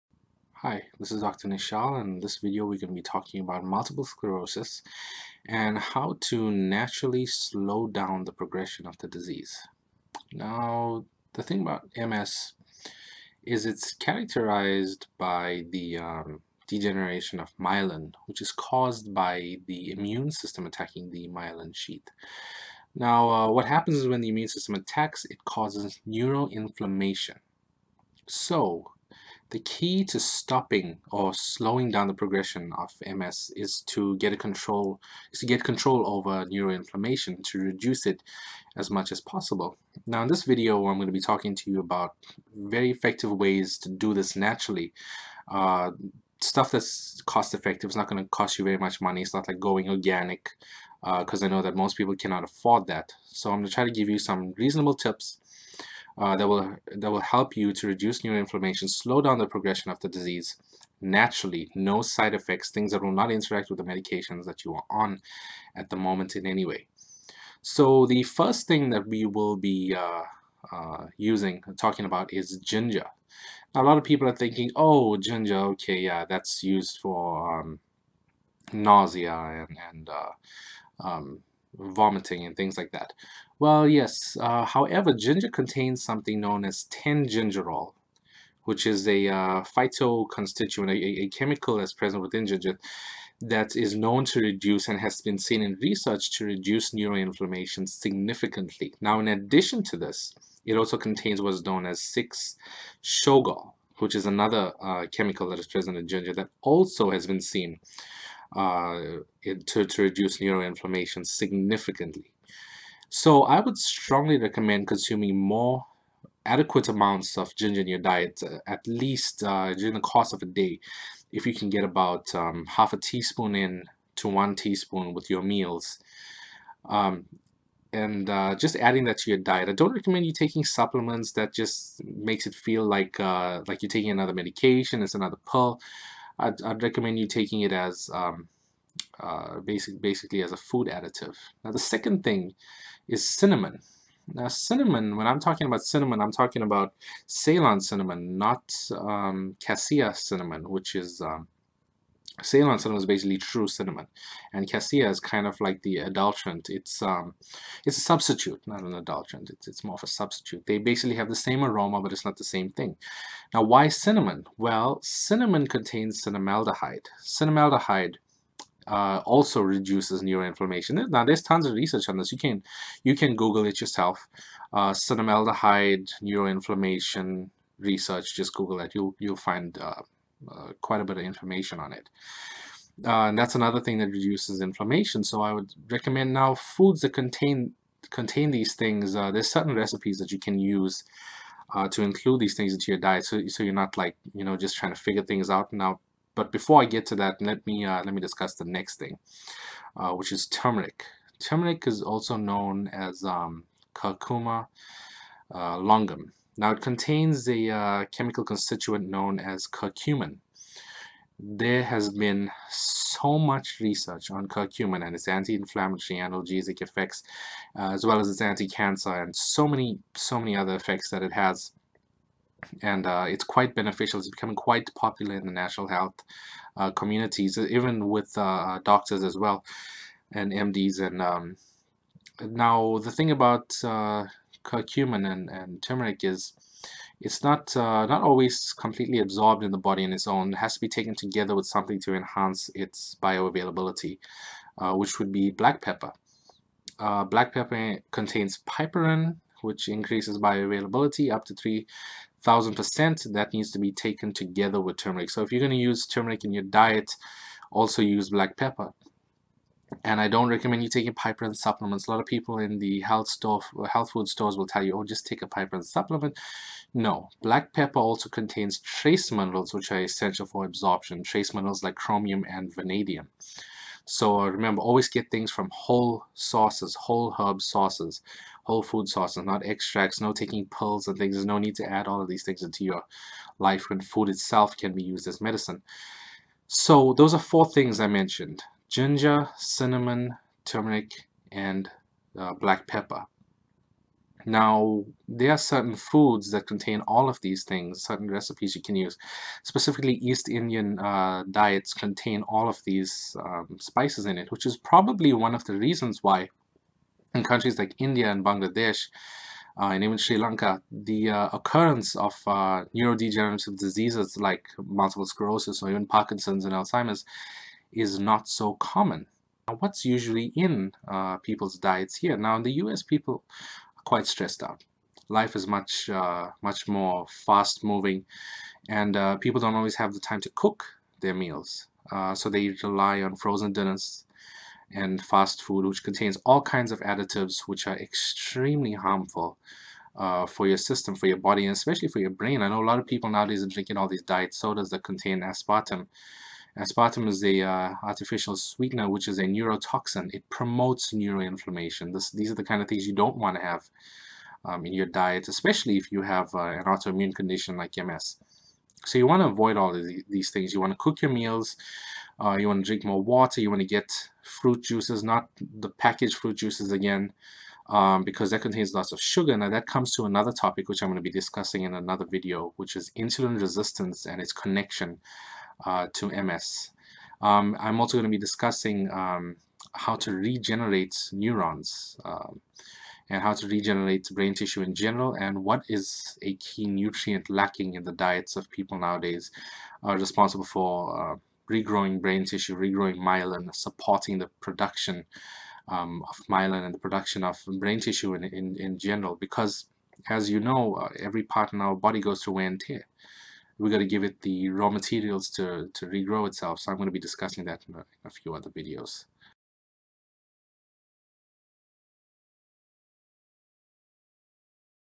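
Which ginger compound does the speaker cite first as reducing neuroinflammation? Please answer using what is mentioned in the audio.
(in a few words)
10-gingerol.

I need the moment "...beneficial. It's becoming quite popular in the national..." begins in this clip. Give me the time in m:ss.
3:43.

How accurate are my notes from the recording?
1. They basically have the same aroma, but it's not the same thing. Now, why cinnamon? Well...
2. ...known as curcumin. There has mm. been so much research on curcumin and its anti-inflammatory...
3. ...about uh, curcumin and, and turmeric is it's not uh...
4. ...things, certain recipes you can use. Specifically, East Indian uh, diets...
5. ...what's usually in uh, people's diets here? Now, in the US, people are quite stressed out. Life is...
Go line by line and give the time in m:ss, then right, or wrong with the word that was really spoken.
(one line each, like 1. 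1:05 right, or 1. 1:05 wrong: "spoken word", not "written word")
1. 2:40 right
2. 3:29 right
3. 3:53 right
4. 4:57 right
5. 5:19 right.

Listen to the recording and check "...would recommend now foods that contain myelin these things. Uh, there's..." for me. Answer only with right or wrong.
wrong.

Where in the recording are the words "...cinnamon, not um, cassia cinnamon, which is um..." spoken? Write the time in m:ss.
2:27.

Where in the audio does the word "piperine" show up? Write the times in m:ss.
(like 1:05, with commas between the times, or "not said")
4:08, 4:21, 4:25.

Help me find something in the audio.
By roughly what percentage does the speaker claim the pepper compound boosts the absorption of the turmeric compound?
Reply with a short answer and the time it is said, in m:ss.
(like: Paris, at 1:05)
3,000%, at 4:11.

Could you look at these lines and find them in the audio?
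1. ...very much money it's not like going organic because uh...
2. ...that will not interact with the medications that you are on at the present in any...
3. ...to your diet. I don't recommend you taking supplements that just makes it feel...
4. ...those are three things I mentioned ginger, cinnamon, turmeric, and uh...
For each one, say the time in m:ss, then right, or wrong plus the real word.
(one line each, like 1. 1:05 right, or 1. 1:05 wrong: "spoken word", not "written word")
1. 0:48 right
2. 1:02 wrong: "moment", not "present"
3. 2:09 right
4. 4:47 wrong: "four", not "three".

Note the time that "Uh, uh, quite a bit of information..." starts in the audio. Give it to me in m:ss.
2:59.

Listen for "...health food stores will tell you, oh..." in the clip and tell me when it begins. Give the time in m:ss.
4:23.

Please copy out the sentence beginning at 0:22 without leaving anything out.
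Now uh, what happens is when the immune system attacks it causes neural inflammation.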